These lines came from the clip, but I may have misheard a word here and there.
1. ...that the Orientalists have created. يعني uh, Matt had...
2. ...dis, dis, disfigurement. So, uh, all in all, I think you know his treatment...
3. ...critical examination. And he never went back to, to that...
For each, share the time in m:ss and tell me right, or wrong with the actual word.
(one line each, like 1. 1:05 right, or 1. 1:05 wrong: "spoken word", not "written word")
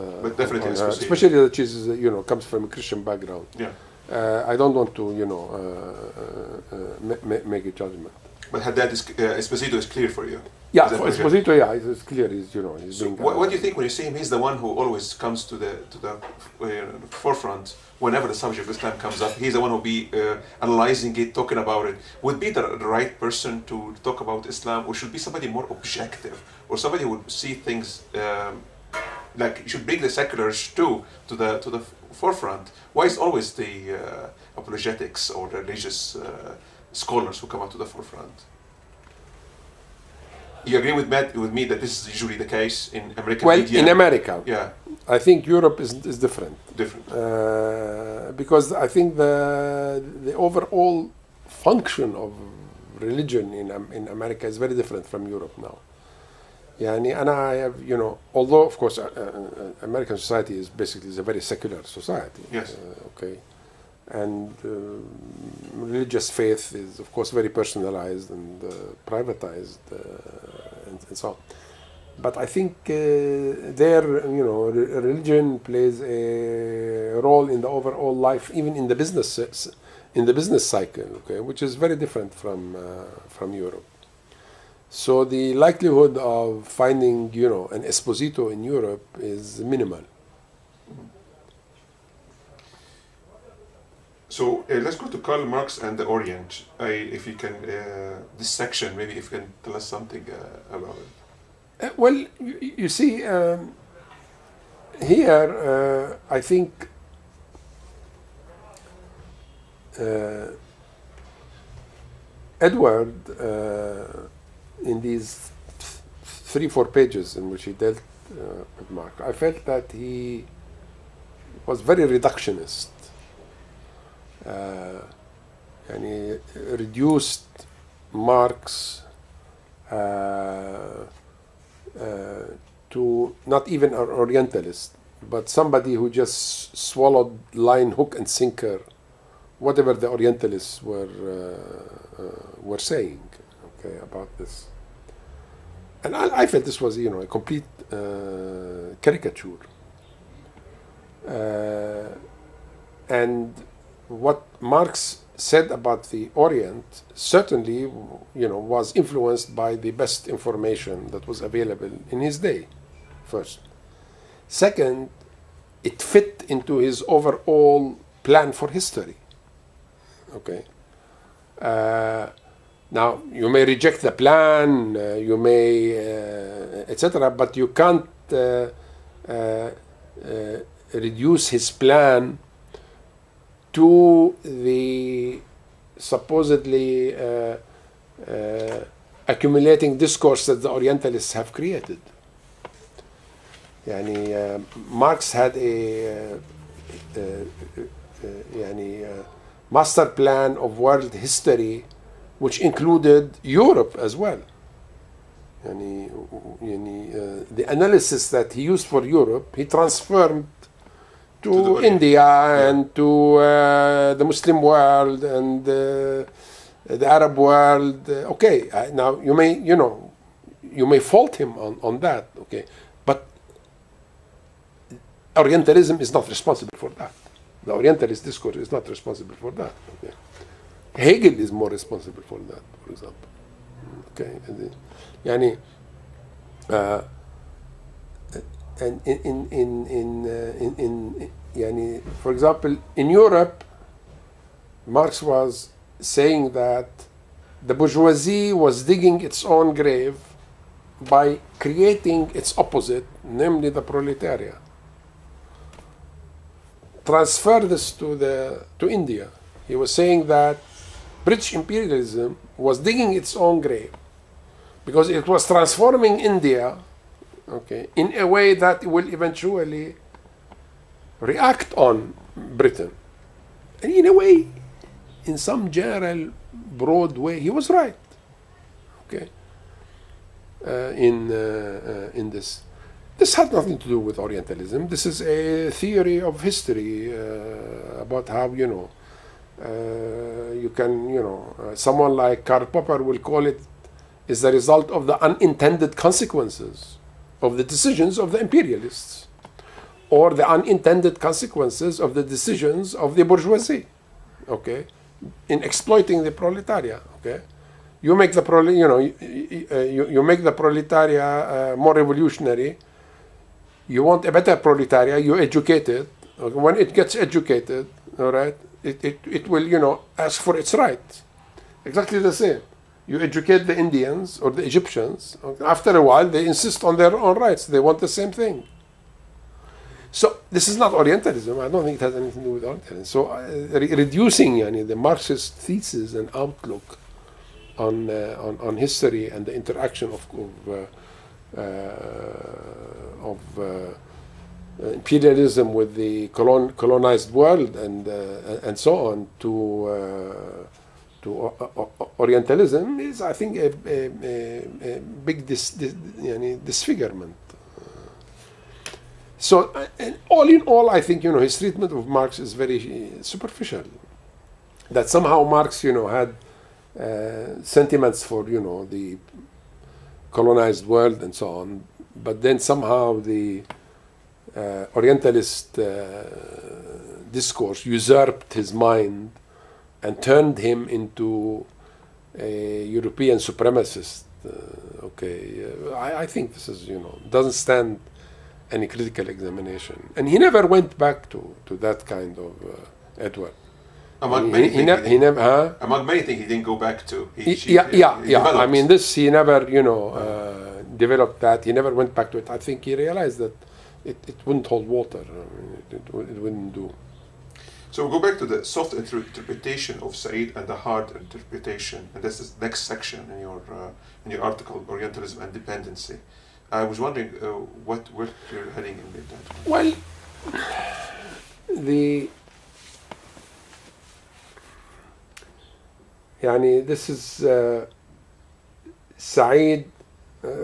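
1. 3:10 wrong: "Marx", not "Matt"
2. 5:55 right
3. 6:28 right.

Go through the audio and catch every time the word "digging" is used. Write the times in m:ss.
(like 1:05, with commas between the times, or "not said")
4:08, 4:22.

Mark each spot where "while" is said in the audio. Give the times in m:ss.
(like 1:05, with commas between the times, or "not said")
5:26.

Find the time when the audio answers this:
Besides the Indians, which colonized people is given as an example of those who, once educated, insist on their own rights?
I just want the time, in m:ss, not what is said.
5:24.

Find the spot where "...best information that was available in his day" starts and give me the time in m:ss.
2:39.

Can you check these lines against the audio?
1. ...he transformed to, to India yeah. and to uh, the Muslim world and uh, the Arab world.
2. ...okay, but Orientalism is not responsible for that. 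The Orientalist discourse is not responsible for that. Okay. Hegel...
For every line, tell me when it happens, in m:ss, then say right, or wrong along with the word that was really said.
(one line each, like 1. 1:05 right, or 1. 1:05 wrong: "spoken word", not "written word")
1. 3:29 right
2. 3:42 right.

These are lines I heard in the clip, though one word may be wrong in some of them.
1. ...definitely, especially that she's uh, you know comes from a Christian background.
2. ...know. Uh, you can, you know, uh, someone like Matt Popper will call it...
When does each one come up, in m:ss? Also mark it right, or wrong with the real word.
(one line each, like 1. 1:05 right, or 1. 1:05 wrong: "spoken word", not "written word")
1. 0:00 right
2. 4:48 wrong: "Karl", not "Matt".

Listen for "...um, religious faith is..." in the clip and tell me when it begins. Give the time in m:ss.
1:04.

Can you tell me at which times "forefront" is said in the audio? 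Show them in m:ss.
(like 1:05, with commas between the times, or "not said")
0:17, 0:32, 0:37.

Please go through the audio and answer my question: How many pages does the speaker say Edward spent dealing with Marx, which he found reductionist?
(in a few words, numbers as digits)
three, four pages.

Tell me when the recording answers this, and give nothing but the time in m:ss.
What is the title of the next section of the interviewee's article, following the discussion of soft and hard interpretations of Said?
6:54.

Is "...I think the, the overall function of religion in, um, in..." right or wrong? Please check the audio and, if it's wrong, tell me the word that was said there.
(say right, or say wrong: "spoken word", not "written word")
right.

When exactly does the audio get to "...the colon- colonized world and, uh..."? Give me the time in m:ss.
5:45.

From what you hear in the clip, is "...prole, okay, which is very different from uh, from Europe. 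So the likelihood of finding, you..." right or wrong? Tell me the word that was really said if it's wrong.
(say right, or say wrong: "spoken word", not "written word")
wrong: "cycle", not "prole".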